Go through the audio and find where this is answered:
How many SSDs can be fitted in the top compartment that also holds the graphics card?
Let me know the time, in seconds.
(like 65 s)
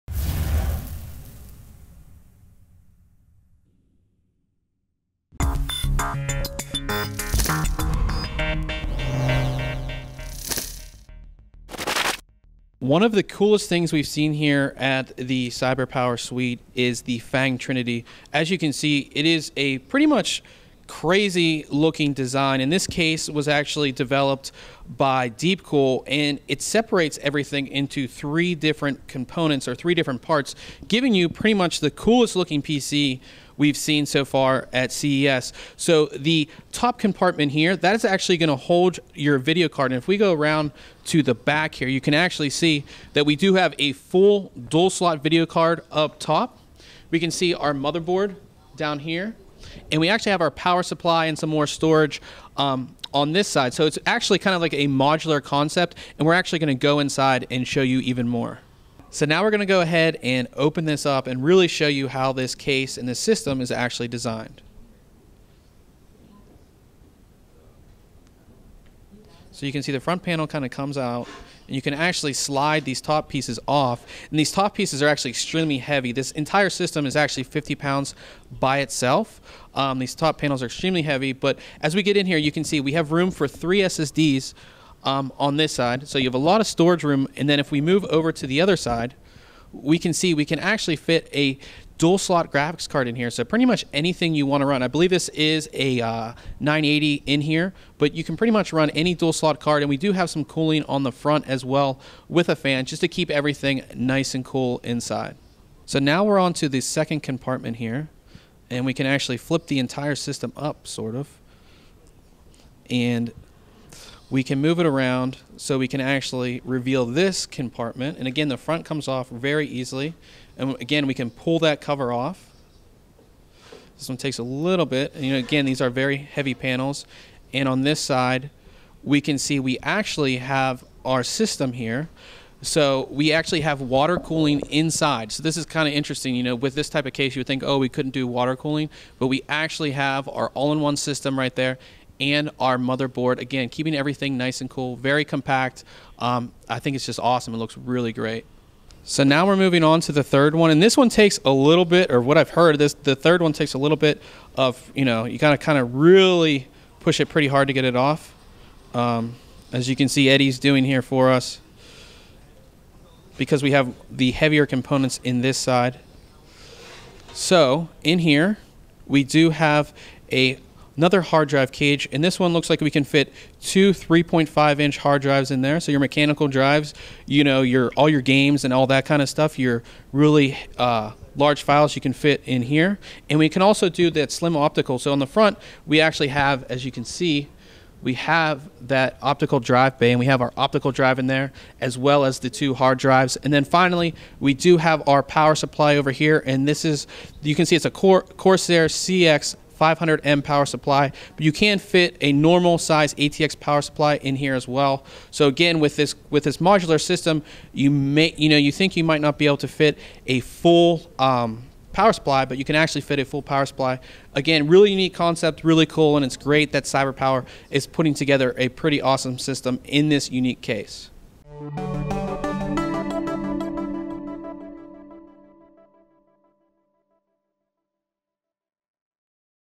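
83 s.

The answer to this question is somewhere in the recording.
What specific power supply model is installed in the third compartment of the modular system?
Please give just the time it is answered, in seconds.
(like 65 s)
198 s.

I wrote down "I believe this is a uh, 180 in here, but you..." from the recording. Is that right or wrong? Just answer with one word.
wrong.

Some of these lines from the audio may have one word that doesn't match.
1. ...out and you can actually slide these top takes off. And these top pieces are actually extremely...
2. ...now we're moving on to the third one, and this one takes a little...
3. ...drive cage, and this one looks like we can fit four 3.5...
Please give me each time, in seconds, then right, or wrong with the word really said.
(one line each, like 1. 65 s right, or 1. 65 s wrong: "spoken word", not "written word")
1. 70 s wrong: "pieces", not "takes"
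2. 149 s right
3. 171 s wrong: "two", not "four".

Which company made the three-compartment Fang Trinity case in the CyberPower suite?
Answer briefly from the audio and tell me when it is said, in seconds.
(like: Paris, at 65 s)
Deepcool, at 25 s.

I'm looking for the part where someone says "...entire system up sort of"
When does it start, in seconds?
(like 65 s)
109 s.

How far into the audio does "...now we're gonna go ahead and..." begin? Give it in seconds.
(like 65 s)
59 s.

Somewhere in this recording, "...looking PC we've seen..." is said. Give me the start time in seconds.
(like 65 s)
32 s.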